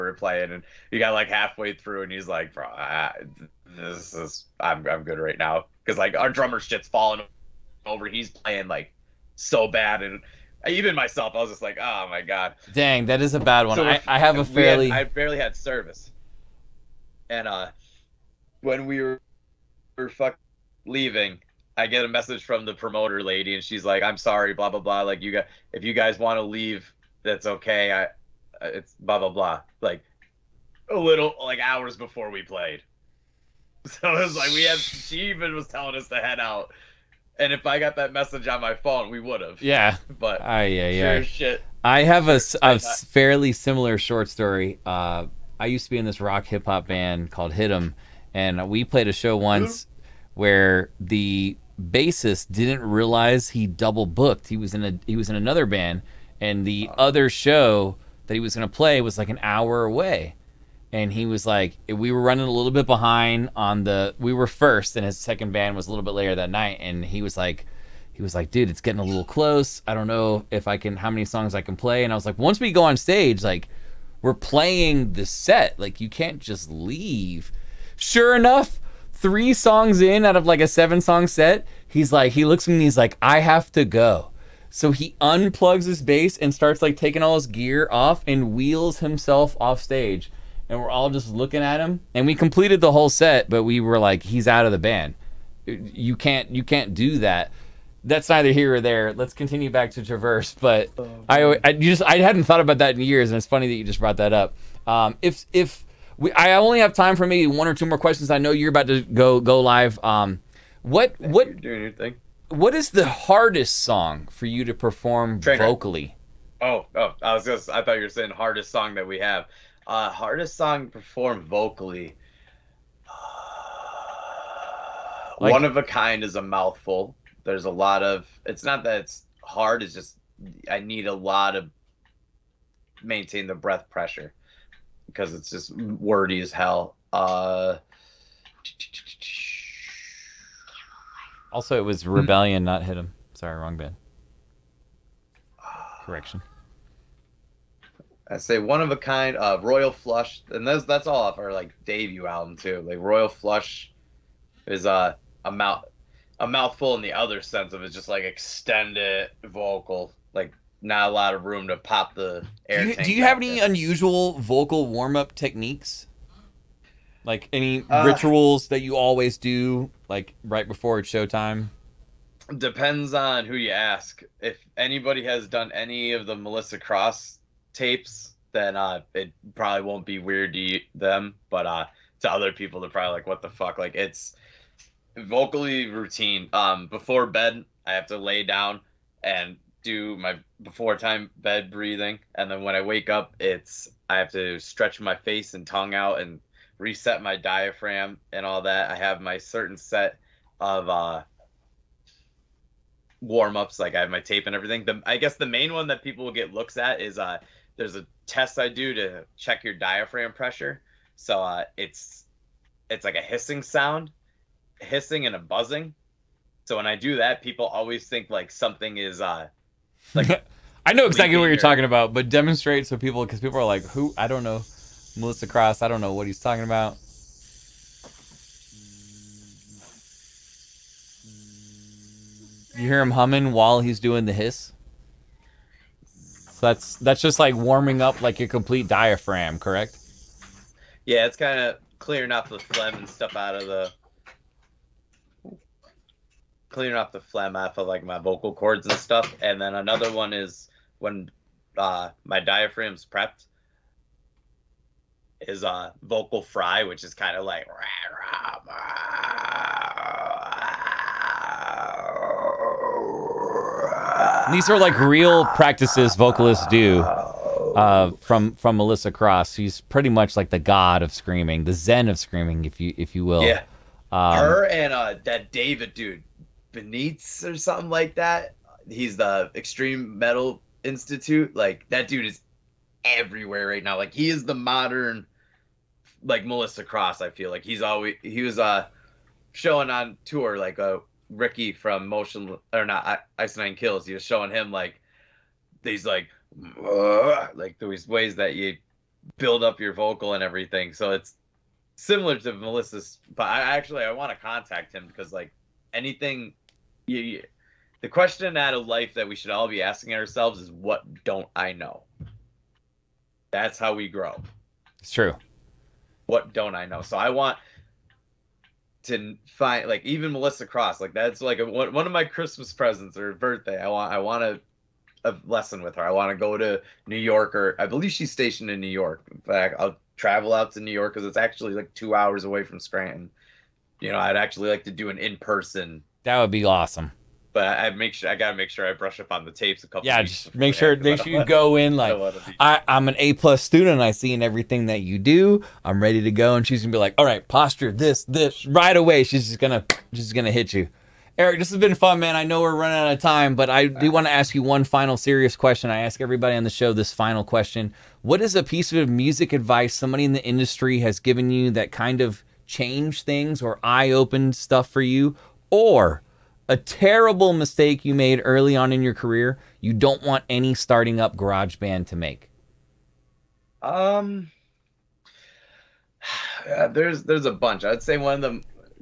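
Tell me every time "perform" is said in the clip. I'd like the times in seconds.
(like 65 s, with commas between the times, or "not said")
114 s, 120 s.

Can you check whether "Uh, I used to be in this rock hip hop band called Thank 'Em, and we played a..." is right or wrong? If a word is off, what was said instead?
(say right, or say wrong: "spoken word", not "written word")
wrong: "Hit", not "Thank".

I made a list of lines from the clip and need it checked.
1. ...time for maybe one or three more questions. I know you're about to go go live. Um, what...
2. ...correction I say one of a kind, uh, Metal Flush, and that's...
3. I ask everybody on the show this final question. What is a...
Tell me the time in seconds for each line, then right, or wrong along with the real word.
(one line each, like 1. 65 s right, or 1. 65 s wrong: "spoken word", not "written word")
1. 106 s wrong: "two", not "three"
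2. 146 s wrong: "Royal", not "Metal"
3. 355 s right.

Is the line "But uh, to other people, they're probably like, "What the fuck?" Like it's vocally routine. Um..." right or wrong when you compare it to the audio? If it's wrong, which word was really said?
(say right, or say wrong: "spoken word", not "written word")
right.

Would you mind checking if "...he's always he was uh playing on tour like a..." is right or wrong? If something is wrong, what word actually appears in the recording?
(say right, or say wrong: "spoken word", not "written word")
wrong: "showing", not "playing".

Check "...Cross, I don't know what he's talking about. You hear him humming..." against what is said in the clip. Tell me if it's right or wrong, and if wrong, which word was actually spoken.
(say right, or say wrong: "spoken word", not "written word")
right.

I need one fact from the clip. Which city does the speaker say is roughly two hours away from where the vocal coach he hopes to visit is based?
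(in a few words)
Scranton.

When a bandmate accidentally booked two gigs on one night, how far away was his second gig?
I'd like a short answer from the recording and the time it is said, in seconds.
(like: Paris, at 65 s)
1 hour, at 59 s.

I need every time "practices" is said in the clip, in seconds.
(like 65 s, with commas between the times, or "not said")
265 s.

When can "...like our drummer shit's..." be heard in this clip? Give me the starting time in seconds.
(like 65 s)
5 s.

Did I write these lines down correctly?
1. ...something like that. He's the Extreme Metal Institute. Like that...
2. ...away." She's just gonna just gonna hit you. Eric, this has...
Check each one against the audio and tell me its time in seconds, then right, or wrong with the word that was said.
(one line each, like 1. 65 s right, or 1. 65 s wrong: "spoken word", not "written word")
1. 277 s right
2. 348 s right.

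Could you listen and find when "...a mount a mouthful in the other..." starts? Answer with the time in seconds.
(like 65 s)
155 s.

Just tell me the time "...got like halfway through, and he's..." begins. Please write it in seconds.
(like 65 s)
0 s.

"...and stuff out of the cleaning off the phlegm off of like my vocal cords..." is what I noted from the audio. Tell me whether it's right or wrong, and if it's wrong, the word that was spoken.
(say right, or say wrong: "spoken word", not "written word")
right.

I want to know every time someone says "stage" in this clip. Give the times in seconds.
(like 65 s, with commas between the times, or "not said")
72 s, 89 s.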